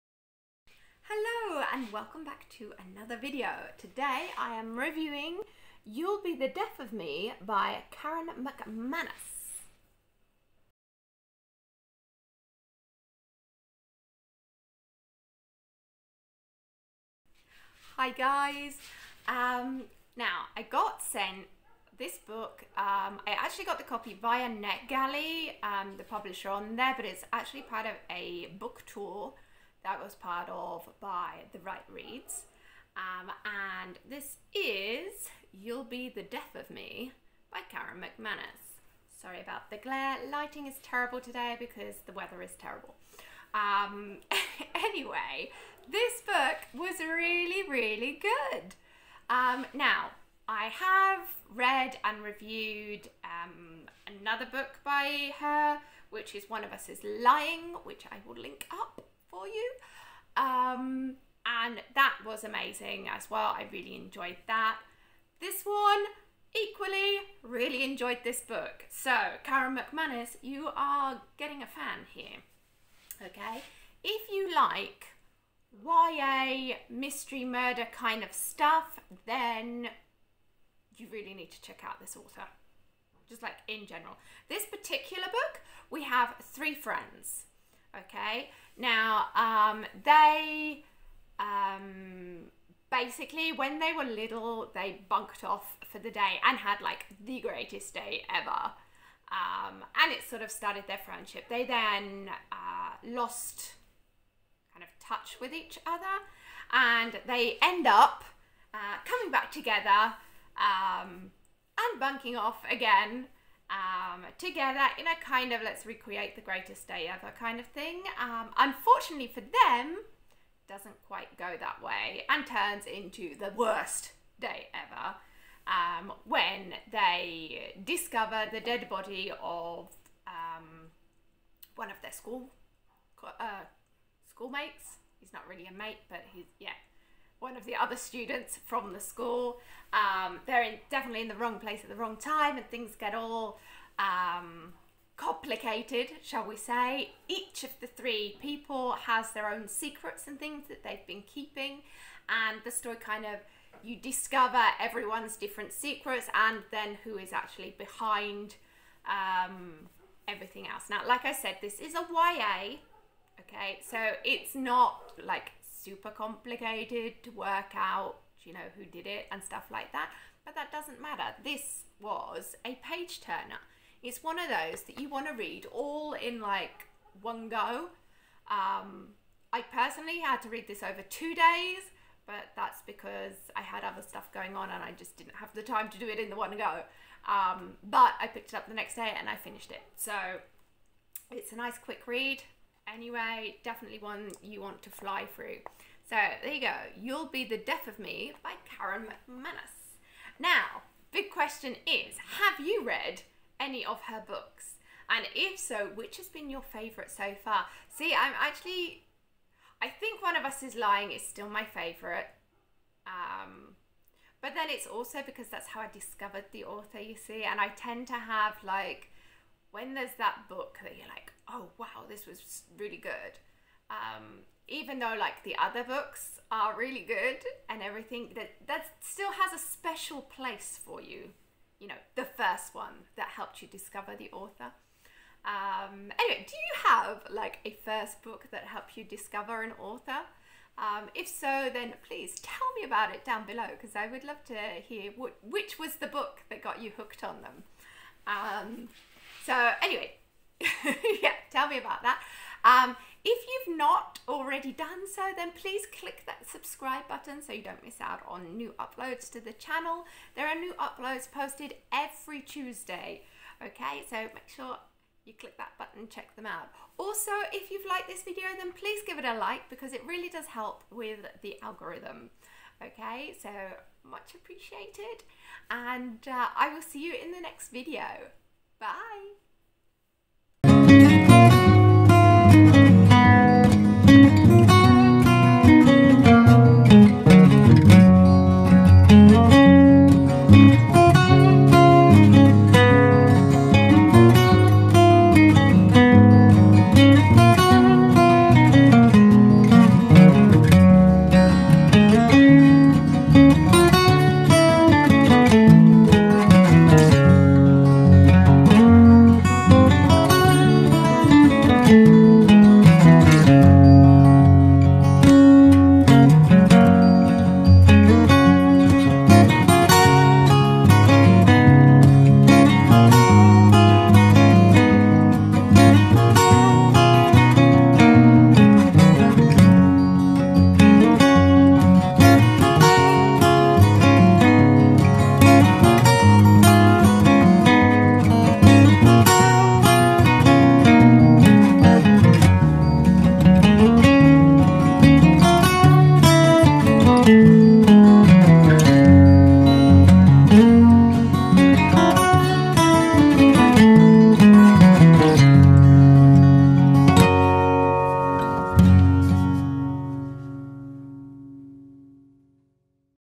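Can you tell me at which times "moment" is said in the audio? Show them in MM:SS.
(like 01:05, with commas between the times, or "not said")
not said.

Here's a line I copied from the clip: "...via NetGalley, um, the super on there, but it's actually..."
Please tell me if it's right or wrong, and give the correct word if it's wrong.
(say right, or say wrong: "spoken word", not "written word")
wrong: "publisher", not "super".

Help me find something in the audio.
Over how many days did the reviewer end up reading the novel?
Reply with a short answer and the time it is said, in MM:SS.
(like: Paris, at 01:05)
2, at 03:01.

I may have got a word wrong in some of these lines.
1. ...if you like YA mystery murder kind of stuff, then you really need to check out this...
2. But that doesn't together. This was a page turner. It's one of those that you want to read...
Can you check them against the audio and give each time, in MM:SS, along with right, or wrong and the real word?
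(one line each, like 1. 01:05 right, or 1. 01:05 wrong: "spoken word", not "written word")
1. 01:14 right
2. 02:50 wrong: "matter", not "together".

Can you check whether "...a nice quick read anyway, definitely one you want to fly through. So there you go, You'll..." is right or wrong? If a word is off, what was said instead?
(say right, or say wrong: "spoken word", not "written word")
right.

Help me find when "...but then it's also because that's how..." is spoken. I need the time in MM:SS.
03:34.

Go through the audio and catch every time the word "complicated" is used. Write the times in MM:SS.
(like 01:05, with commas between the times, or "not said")
02:25, 02:46.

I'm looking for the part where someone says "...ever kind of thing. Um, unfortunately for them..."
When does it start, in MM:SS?
01:57.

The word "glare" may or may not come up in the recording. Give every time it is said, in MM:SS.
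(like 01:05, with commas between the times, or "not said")
00:39.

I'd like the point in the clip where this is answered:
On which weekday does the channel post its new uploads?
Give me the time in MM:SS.
04:22.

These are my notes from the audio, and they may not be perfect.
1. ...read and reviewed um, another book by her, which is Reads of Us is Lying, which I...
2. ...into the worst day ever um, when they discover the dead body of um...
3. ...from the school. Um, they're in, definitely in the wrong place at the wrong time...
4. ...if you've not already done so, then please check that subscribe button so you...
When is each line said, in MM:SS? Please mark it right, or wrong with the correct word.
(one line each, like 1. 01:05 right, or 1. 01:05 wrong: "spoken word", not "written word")
1. 00:51 wrong: "One", not "Reads"
2. 02:02 right
3. 02:18 right
4. 04:13 wrong: "click", not "check".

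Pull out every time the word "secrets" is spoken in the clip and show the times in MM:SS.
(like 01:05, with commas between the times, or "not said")
02:29, 02:35.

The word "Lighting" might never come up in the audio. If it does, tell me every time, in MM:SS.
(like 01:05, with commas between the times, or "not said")
00:40.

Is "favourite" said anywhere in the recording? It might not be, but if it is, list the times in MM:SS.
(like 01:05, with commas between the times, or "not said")
03:26, 03:31.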